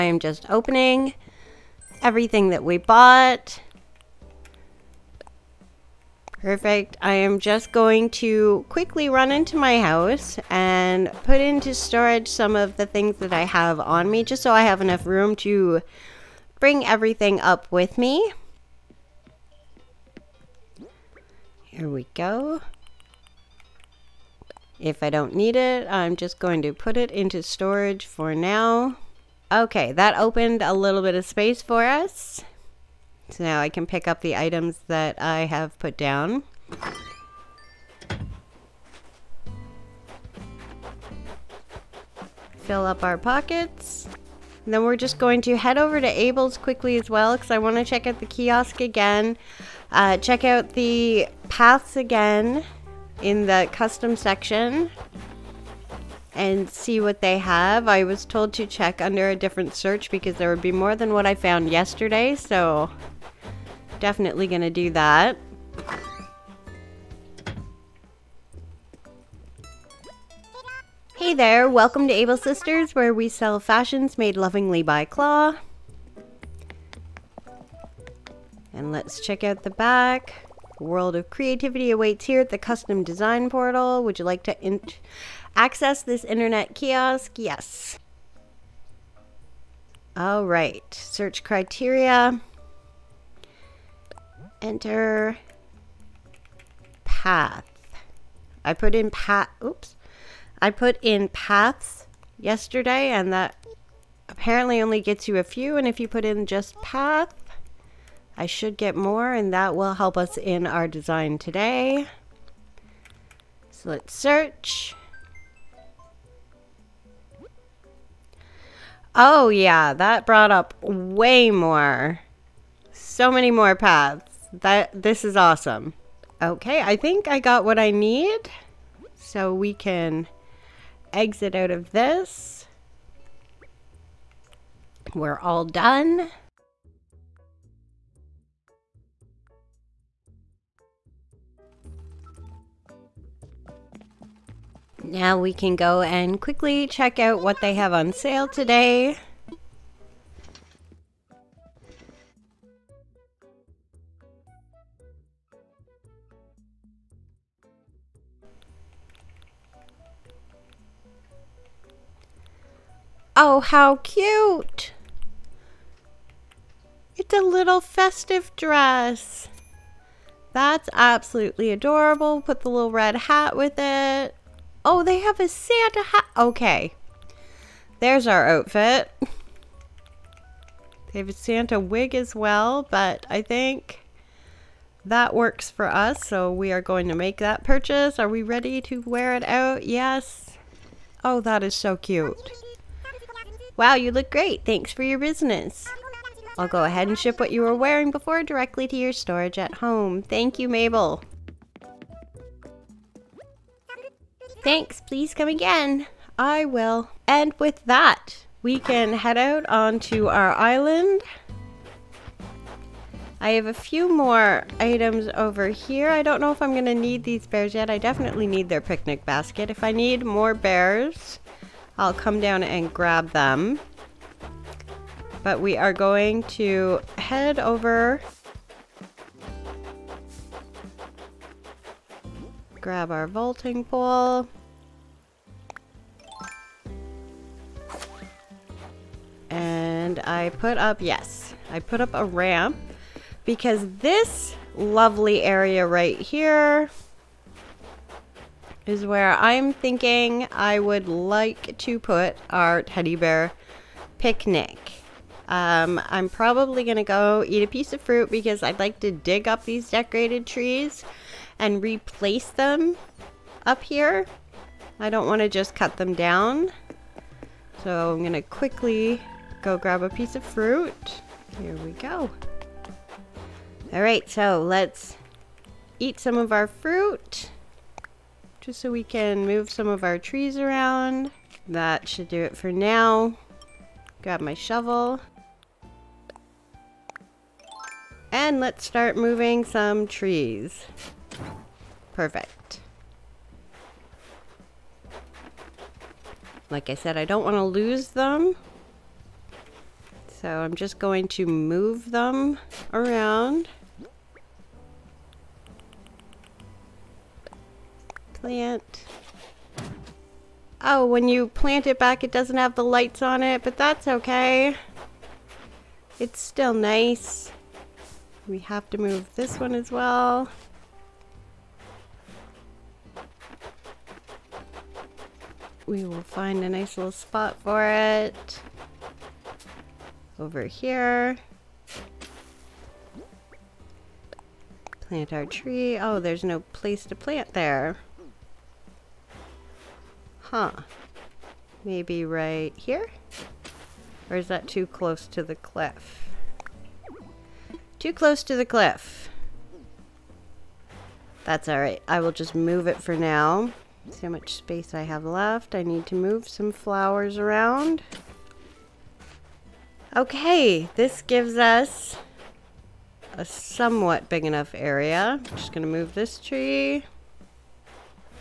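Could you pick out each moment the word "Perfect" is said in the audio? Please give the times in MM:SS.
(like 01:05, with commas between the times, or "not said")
00:06, 04:52.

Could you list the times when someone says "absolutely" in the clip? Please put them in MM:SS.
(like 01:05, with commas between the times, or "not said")
02:50.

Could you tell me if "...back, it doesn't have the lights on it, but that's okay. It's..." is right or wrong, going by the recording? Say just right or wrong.
right.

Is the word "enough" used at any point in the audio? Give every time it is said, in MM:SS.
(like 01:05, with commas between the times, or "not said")
00:14, 06:04.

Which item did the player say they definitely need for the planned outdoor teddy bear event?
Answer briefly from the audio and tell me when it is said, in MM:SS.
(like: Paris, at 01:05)
picnic basket, at 03:38.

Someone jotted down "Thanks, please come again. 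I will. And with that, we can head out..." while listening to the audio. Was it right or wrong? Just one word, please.
right.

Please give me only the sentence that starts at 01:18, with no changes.
And let's check out the back world of creativity awaits here at the custom design portal.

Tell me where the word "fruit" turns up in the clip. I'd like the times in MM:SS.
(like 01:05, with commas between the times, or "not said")
04:18, 04:30, 04:36.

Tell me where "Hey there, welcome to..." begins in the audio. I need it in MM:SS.
01:11.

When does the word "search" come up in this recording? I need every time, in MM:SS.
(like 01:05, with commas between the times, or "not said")
00:59, 01:30, 01:54.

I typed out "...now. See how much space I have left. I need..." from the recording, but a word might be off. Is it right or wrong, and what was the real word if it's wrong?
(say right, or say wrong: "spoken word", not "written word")
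right.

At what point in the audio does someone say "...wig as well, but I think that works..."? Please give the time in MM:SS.
03:01.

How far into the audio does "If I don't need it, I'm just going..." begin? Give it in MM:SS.
00:24.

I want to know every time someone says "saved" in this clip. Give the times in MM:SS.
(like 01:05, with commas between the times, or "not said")
not said.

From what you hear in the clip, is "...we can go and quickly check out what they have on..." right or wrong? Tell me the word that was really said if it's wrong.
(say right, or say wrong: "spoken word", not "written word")
right.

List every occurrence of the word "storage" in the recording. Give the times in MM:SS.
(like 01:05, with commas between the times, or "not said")
00:11, 00:27, 03:19.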